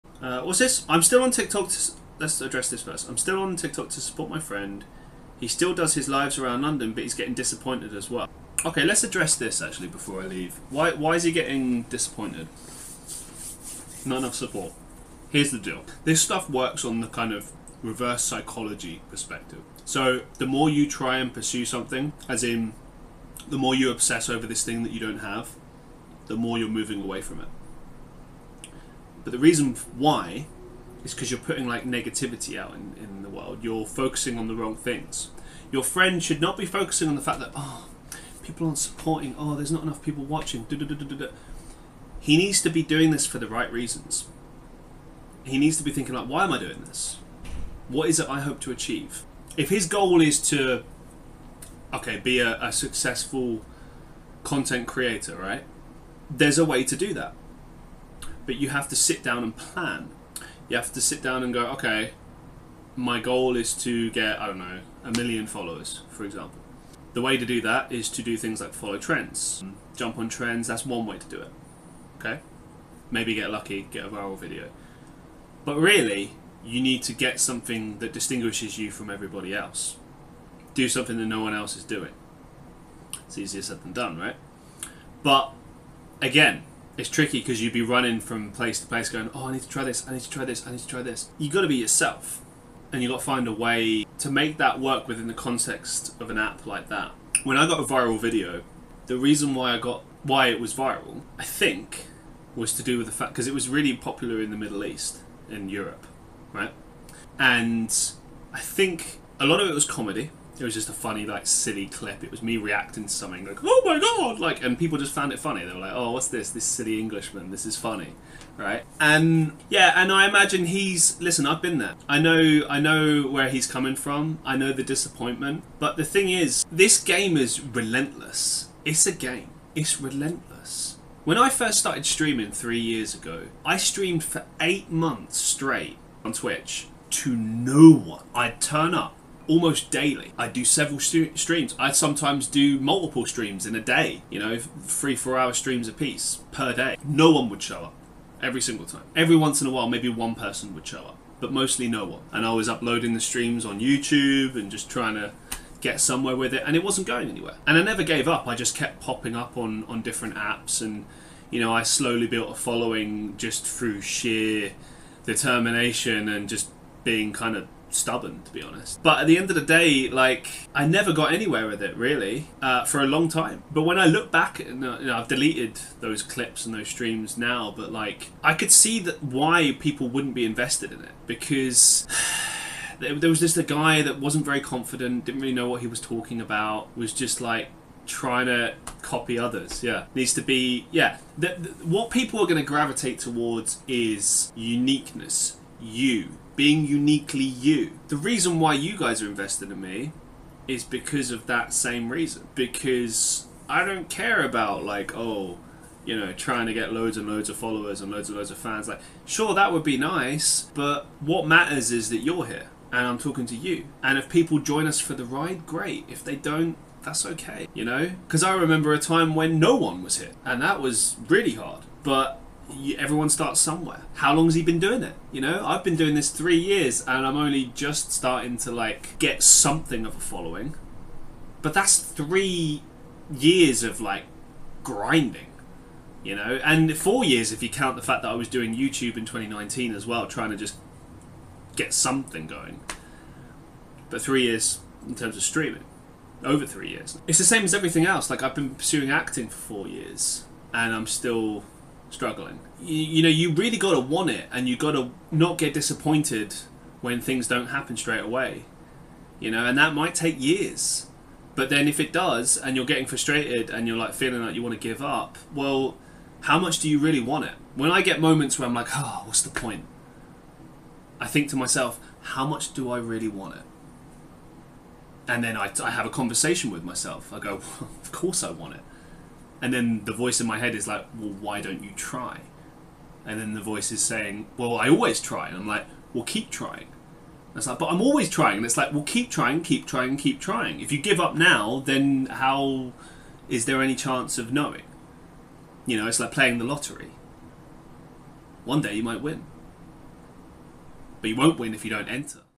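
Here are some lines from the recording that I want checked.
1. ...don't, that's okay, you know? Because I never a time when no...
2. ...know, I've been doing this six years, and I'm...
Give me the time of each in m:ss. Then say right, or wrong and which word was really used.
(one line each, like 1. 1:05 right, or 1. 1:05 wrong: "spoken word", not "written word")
1. 3:36 wrong: "remember", not "never"
2. 3:45 wrong: "three", not "six".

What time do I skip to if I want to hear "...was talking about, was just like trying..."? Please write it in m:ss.
3:05.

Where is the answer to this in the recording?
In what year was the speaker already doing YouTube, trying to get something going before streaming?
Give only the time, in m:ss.
3:59.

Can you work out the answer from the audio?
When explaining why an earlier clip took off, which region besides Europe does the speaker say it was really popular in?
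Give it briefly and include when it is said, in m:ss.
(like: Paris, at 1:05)
Middle East, at 1:44.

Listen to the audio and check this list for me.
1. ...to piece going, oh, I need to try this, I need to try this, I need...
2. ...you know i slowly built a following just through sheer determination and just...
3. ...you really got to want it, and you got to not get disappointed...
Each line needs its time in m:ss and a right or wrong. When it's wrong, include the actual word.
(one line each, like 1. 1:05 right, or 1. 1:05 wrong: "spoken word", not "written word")
1. 1:28 wrong: "place", not "piece"
2. 2:41 right
3. 4:13 right.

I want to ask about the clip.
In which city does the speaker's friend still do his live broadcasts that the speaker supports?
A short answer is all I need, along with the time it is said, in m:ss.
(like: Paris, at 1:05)
London, at 0:06.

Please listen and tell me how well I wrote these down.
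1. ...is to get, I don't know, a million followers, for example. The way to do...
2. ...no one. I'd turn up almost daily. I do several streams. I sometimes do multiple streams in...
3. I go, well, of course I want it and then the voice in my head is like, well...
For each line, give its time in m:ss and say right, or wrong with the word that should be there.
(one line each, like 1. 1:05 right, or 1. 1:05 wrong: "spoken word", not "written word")
1. 1:03 right
2. 2:17 right
3. 4:37 right.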